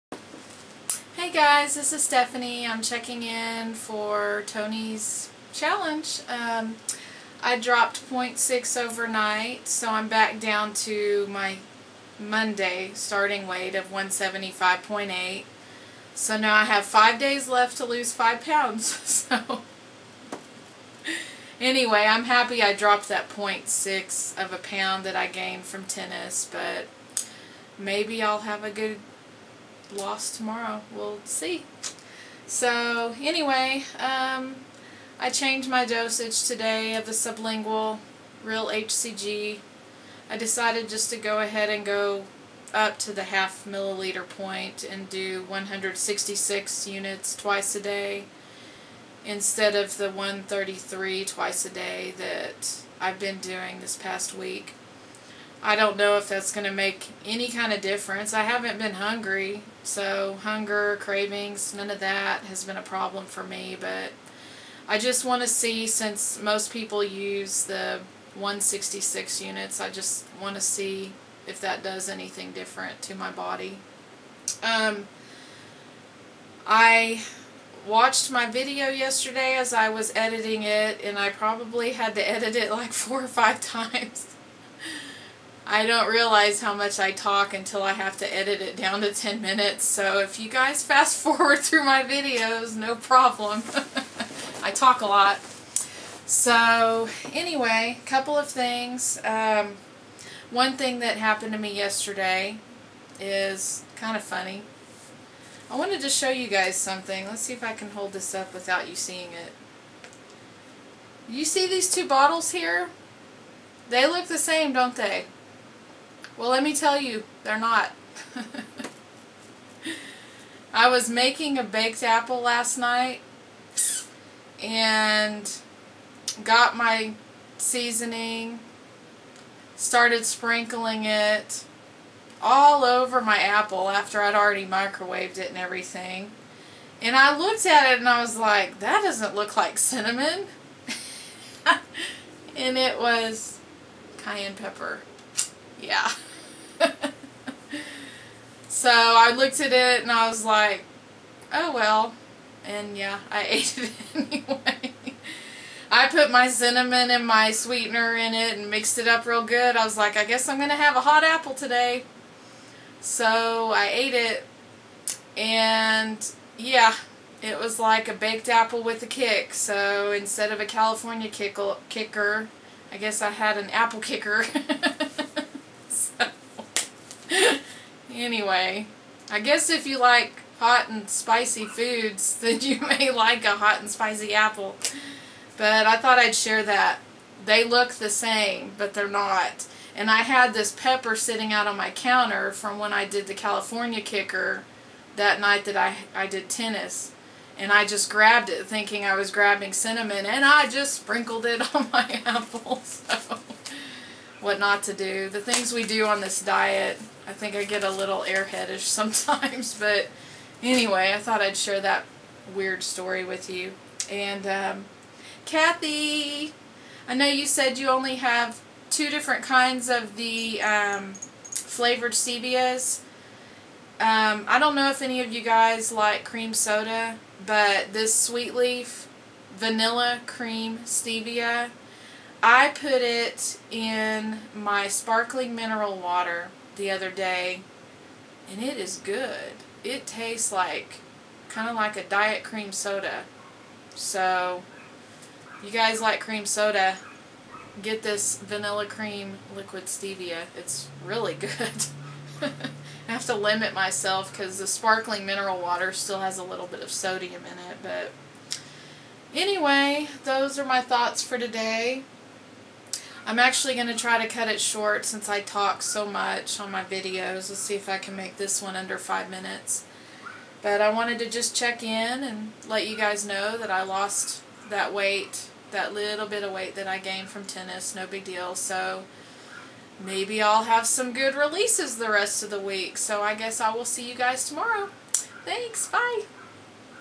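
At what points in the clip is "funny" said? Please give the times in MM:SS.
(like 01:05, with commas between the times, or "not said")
01:44.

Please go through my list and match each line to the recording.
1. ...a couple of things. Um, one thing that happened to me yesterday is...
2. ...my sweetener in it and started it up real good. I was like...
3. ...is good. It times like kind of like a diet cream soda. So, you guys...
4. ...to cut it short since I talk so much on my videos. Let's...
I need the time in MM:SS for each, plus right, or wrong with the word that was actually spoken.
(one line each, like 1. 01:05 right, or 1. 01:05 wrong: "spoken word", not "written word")
1. 01:38 right
2. 02:37 wrong: "mixed", not "started"
3. 03:58 wrong: "tastes", not "times"
4. 04:24 right.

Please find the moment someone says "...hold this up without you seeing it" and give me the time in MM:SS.
01:47.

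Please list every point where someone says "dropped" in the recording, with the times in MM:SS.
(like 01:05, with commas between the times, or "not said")
00:07, 00:22.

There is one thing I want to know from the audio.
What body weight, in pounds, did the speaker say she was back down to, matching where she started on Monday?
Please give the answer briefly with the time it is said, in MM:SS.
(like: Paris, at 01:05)
175.8, at 00:13.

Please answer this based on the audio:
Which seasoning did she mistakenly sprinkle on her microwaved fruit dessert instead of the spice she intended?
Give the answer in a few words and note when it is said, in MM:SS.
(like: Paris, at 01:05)
cayenne pepper, at 02:24.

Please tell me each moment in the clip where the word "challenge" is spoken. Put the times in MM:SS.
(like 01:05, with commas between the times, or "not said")
00:05.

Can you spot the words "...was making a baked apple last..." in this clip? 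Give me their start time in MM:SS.
02:00.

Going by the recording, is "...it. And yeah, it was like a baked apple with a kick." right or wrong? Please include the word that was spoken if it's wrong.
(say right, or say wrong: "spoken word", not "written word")
right.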